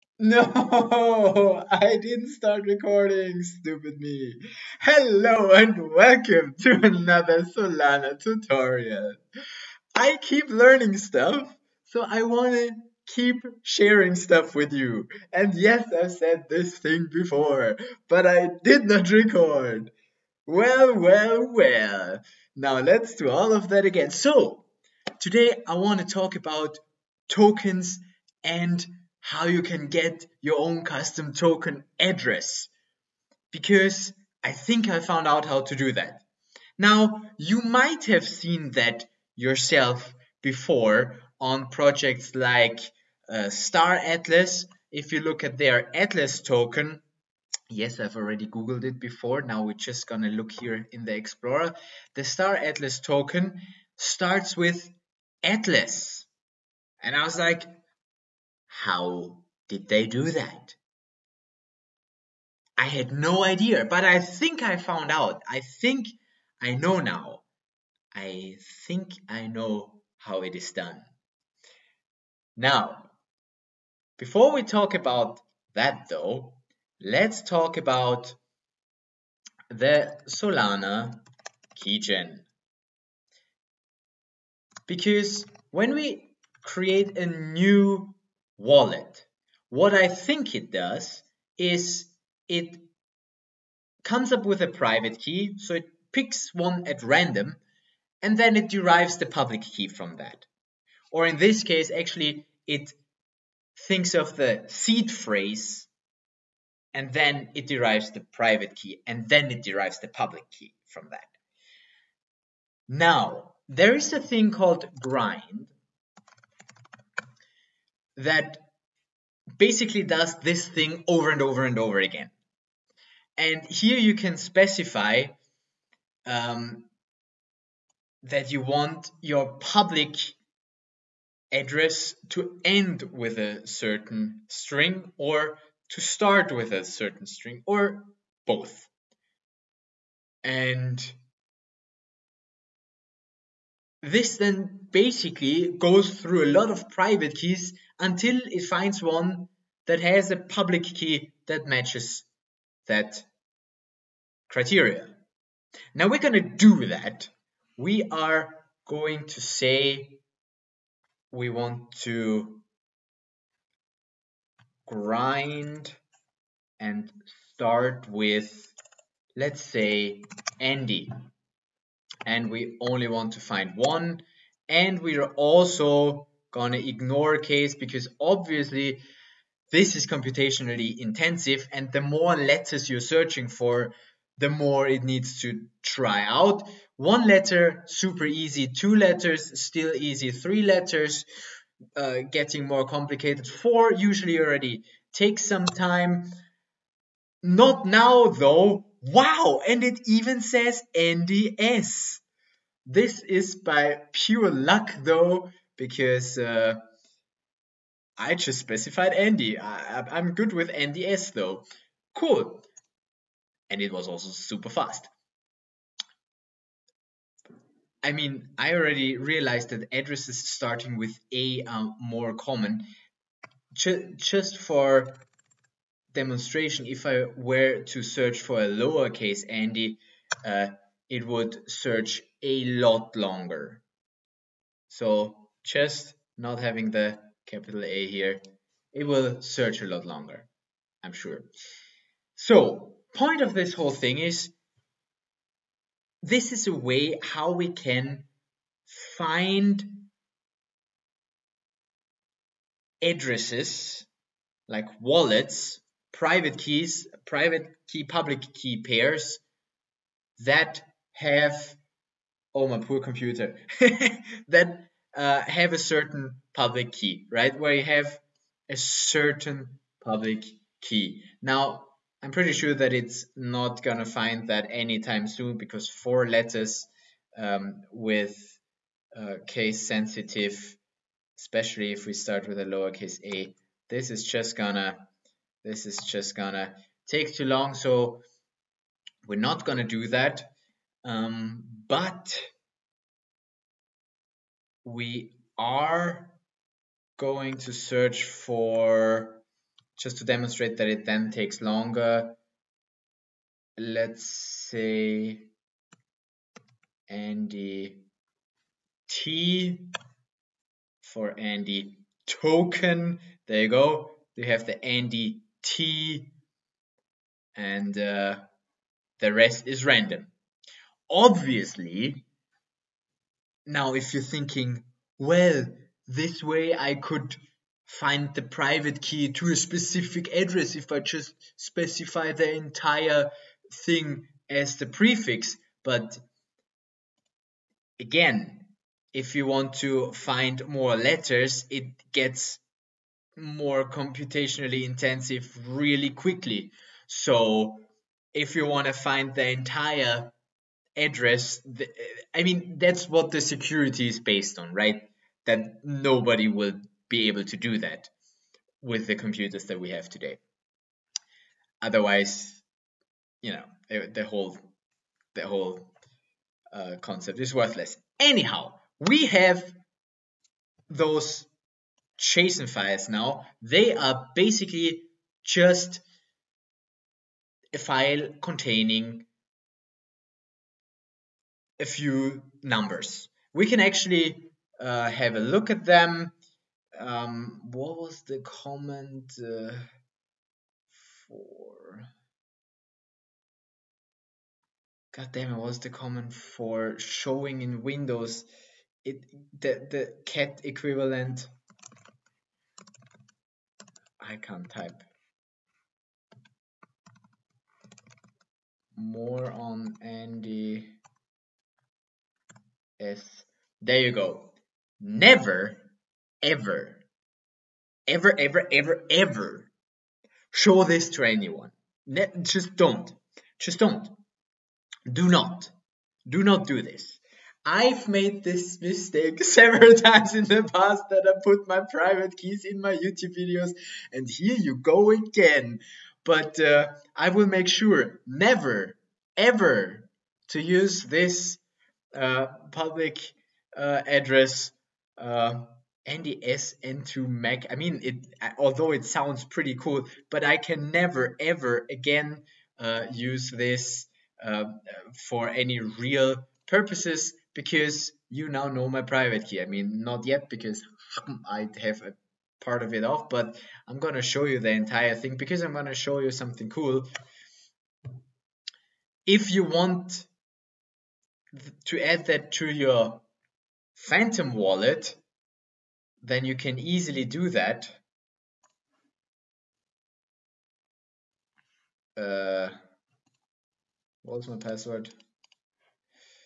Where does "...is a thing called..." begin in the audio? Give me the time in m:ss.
1:53.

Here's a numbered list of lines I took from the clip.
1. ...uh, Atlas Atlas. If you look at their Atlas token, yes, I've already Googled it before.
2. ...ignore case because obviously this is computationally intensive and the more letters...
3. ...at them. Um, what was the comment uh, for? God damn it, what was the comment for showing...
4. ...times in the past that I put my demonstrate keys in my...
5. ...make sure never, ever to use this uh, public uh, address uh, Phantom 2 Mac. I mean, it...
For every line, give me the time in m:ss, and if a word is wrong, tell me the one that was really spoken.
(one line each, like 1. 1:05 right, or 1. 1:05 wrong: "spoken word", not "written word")
1. 0:43 wrong: "Star", not "Atlas"
2. 2:56 right
3. 6:25 right
4. 7:09 wrong: "private", not "demonstrate"
5. 7:17 wrong: "NDSN", not "Phantom".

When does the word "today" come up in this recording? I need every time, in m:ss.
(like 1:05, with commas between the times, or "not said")
0:25, 6:00.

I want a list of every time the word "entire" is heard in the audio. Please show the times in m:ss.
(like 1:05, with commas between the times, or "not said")
5:32, 5:49, 7:44.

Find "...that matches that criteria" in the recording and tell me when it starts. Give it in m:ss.
2:31.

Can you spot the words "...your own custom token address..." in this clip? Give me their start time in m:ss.
0:30.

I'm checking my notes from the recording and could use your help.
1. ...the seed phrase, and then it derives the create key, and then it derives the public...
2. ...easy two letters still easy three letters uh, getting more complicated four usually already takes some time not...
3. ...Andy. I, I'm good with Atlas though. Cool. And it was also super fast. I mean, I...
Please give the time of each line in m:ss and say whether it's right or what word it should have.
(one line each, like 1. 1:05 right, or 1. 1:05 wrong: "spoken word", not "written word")
1. 1:44 wrong: "private", not "create"
2. 3:08 right
3. 3:29 wrong: "NDS", not "Atlas".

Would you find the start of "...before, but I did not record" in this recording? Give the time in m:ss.
0:17.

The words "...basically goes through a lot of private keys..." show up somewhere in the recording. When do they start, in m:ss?
2:24.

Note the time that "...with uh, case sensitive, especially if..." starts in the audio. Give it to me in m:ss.
4:37.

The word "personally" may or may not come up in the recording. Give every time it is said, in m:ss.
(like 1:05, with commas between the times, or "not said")
not said.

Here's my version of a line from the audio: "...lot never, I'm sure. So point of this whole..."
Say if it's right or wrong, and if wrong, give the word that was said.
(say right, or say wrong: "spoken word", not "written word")
wrong: "longer", not "never".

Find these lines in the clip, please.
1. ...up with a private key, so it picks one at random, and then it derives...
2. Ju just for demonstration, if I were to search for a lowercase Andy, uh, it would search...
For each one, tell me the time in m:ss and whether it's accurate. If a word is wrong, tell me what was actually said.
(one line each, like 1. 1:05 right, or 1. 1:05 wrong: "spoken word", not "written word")
1. 1:34 right
2. 3:43 right.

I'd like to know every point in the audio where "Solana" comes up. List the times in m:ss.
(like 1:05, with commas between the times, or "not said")
0:07, 1:20.